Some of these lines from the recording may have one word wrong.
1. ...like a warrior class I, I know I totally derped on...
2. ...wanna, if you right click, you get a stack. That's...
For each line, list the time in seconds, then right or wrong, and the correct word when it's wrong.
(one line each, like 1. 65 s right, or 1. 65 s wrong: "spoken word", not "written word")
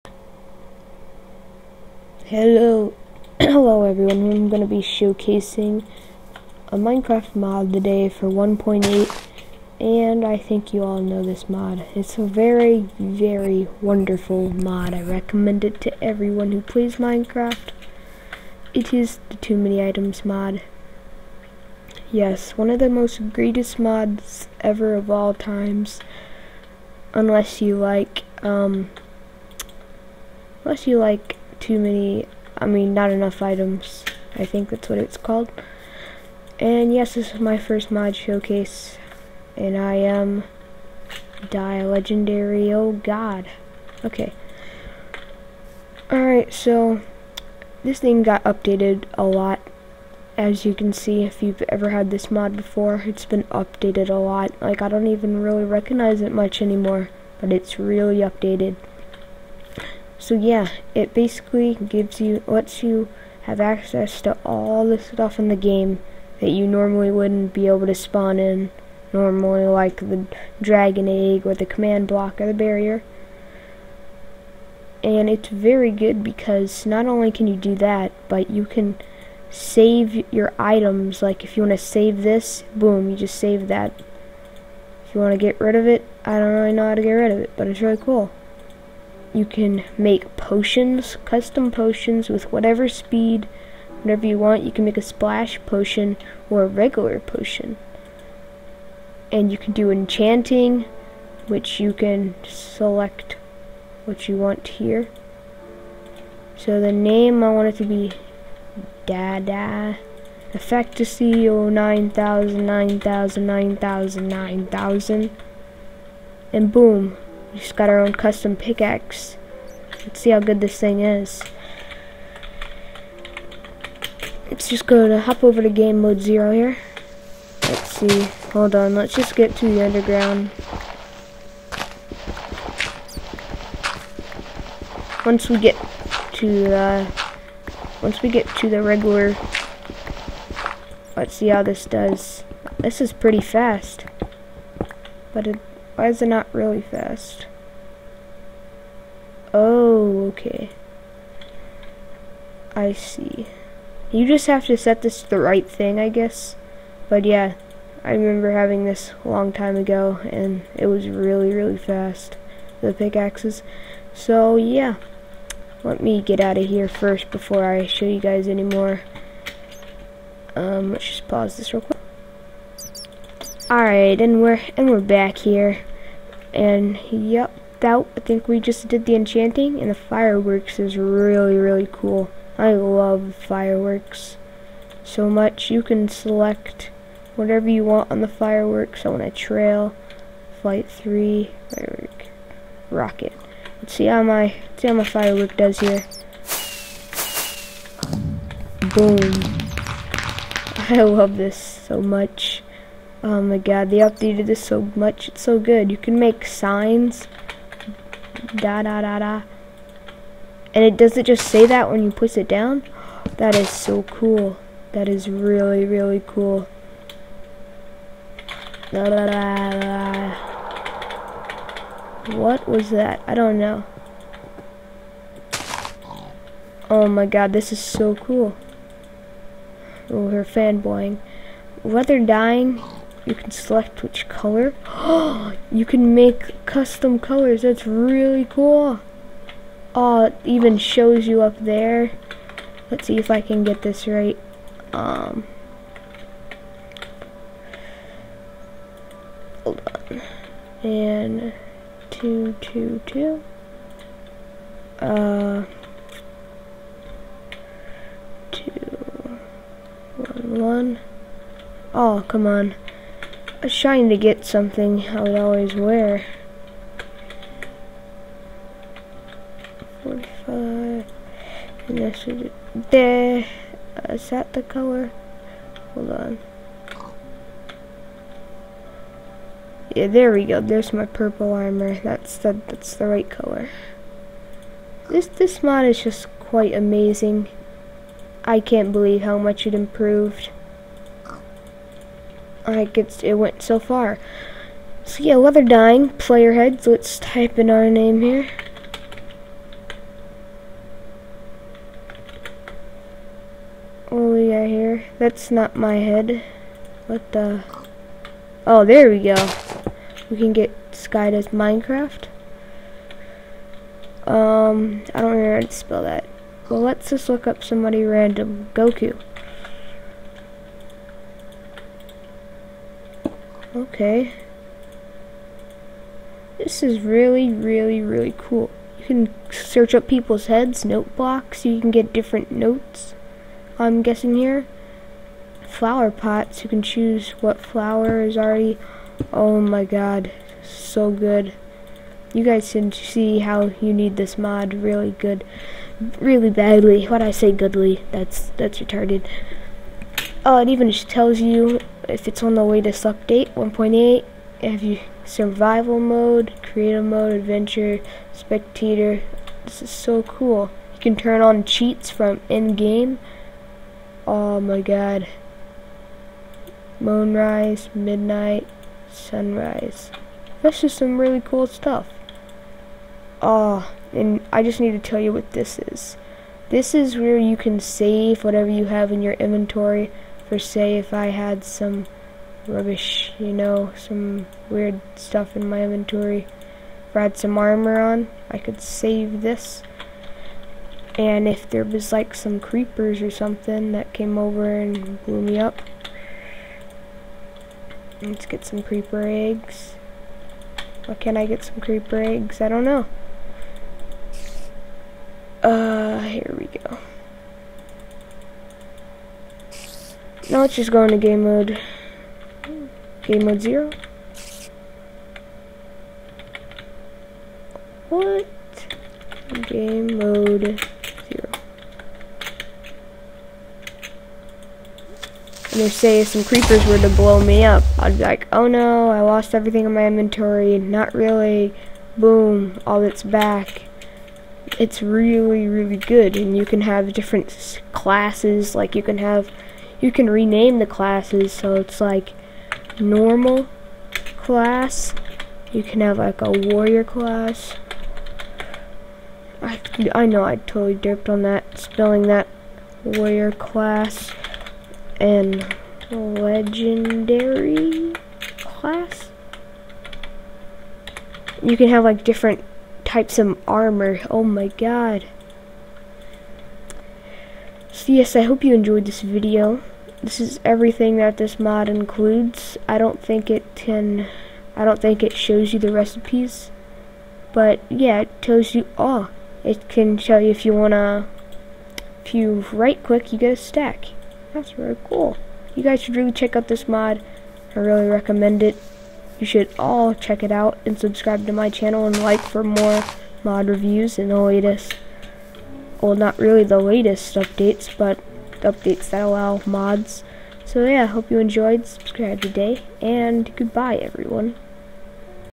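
1. 446 s right
2. 480 s right.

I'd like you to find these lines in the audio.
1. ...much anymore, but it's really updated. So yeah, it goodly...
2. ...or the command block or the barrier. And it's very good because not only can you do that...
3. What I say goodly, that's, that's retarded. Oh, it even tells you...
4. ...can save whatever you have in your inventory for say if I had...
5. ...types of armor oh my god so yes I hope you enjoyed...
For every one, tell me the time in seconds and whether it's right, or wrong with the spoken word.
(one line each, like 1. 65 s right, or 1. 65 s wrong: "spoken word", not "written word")
1. 56 s wrong: "basically", not "goodly"
2. 71 s right
3. 347 s right
4. 377 s right
5. 463 s right.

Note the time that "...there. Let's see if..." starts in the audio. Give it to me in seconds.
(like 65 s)
241 s.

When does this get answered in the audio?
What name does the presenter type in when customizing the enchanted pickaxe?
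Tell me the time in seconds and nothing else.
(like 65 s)
109 s.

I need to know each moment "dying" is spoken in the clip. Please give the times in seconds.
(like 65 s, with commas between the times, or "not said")
232 s, 295 s.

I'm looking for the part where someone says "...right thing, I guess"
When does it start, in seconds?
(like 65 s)
155 s.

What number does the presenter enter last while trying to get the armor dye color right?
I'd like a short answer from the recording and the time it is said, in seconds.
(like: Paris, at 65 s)
45, at 270 s.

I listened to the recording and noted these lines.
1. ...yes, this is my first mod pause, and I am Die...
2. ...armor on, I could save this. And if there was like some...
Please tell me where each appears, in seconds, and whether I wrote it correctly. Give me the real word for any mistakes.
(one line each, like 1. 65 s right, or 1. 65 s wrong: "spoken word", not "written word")
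1. 36 s wrong: "showcase", not "pause"
2. 387 s right.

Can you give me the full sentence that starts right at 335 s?
Flower pots, you can choose what flower is already, oh my god, so good.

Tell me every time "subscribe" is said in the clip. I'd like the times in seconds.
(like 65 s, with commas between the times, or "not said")
490 s, 501 s.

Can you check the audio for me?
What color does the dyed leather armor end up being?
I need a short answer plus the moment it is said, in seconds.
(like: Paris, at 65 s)
Purple, at 281 s.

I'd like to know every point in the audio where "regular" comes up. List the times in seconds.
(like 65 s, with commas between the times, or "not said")
96 s, 138 s.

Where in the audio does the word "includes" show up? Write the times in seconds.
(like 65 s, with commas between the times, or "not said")
471 s.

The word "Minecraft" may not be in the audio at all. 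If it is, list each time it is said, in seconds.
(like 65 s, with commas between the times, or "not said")
6 s, 16 s, 311 s.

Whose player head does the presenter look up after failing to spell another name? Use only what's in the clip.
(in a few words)
Goku.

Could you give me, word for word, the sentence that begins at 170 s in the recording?
Um, let's just pause this real quick.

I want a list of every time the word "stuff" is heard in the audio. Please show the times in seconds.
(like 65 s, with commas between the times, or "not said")
64 s, 371 s, 385 s.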